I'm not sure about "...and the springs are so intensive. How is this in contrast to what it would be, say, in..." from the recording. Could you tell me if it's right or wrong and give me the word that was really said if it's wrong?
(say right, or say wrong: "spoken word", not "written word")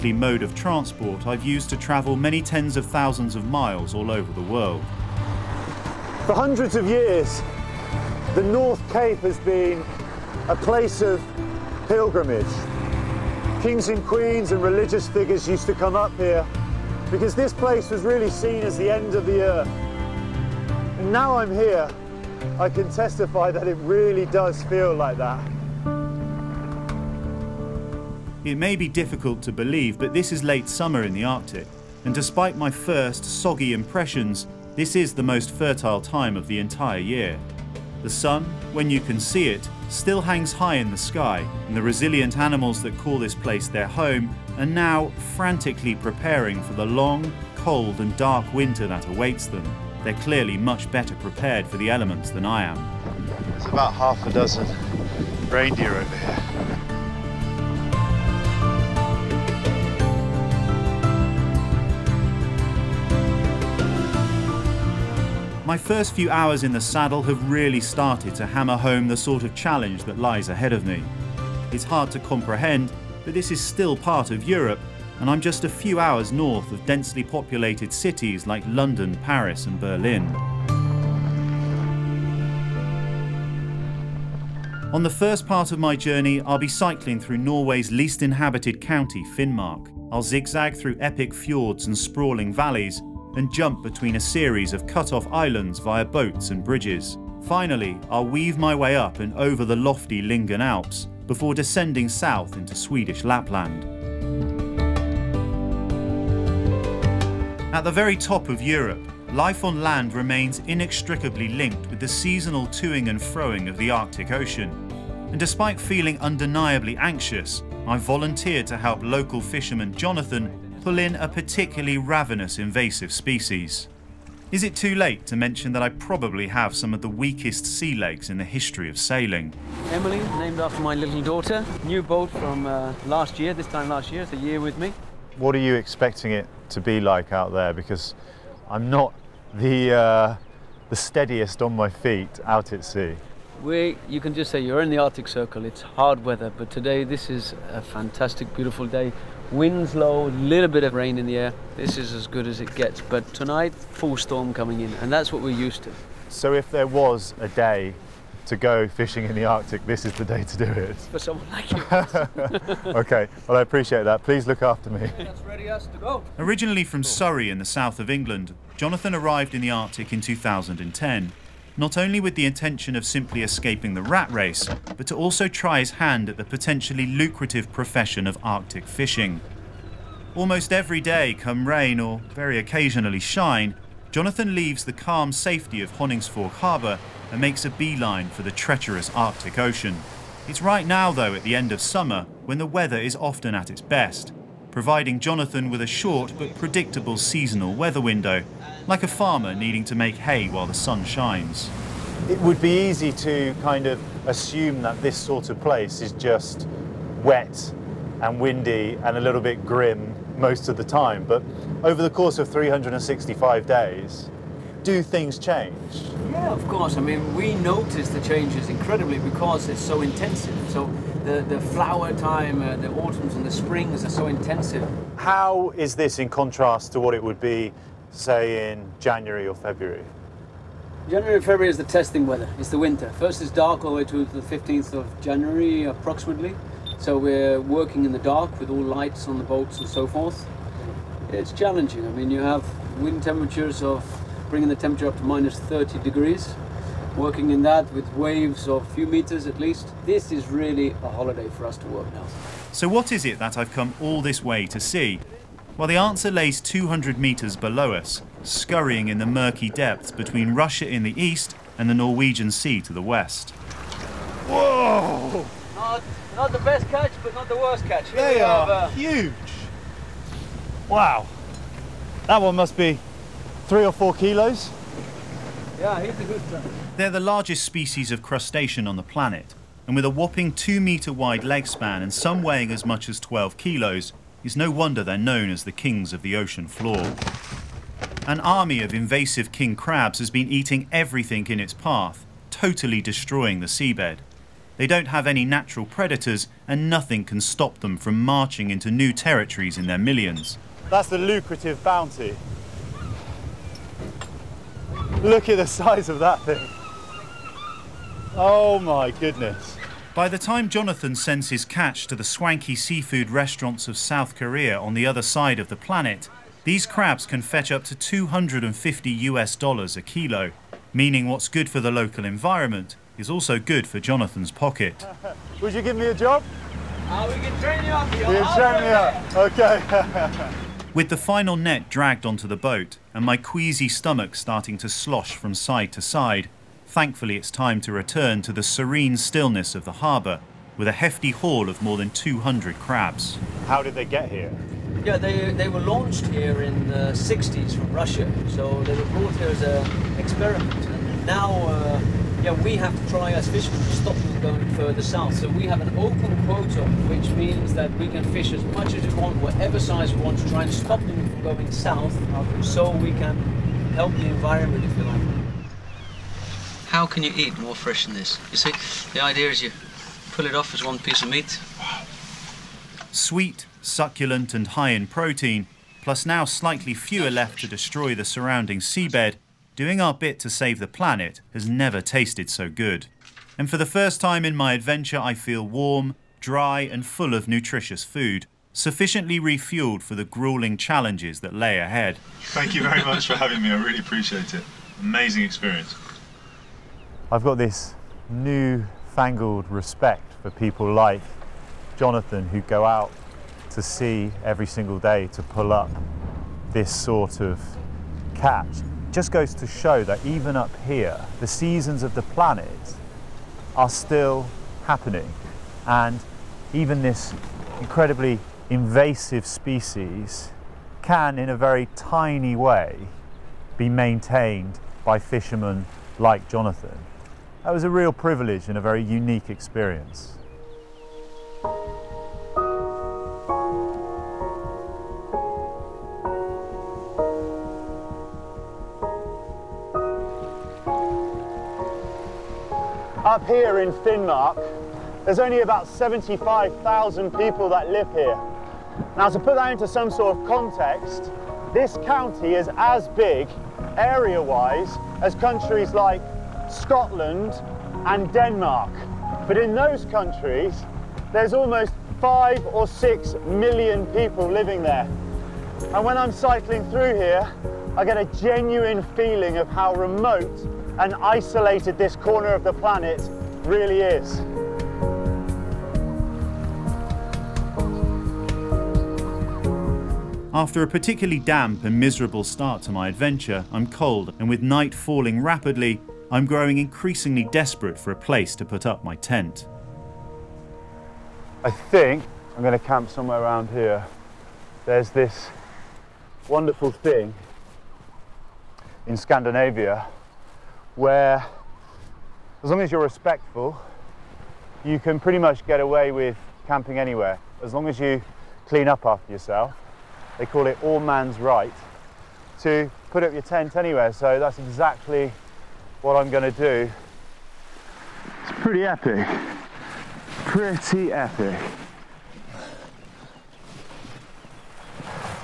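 right.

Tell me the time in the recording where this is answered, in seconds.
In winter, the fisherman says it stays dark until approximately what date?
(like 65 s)
234 s.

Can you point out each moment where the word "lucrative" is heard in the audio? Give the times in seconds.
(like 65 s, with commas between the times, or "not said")
177 s, 301 s.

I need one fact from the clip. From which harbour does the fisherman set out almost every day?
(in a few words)
Honningsvåg Harbour.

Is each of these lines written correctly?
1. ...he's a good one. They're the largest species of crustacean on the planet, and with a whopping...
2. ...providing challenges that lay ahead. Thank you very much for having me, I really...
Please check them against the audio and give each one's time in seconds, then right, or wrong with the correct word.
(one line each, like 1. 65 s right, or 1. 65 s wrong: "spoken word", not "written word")
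1. 275 s right
2. 390 s wrong: "grueling", not "providing".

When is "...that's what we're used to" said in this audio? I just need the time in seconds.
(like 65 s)
155 s.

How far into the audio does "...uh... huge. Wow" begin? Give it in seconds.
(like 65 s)
268 s.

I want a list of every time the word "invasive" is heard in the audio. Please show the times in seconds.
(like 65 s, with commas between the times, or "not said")
122 s, 288 s, 418 s.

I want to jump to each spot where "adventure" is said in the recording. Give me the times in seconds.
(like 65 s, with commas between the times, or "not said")
384 s, 483 s.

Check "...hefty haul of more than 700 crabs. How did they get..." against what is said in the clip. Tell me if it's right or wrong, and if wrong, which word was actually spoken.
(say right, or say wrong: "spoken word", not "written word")
wrong: "200", not "700".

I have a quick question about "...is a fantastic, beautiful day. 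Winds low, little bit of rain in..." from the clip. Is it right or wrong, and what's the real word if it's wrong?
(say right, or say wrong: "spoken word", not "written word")
right.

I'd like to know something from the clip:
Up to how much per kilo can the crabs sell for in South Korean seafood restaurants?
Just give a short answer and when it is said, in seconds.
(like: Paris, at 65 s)
250 US dollars, at 317 s.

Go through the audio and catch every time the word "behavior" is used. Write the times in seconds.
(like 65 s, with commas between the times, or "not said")
not said.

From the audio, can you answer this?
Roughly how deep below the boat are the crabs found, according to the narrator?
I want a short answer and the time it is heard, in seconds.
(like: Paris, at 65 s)
200 metres, at 256 s.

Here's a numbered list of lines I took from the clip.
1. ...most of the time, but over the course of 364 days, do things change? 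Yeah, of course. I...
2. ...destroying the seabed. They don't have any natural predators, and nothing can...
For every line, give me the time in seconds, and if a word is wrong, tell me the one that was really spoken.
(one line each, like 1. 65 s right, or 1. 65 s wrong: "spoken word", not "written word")
1. 210 s wrong: "365", not "364"
2. 292 s right.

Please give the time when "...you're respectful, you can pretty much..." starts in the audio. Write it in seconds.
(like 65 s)
502 s.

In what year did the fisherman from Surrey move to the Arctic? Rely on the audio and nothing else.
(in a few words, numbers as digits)
2010.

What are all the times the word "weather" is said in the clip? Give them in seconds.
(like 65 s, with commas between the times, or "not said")
146 s, 192 s, 197 s, 232 s.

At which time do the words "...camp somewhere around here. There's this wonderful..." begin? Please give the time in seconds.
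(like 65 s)
492 s.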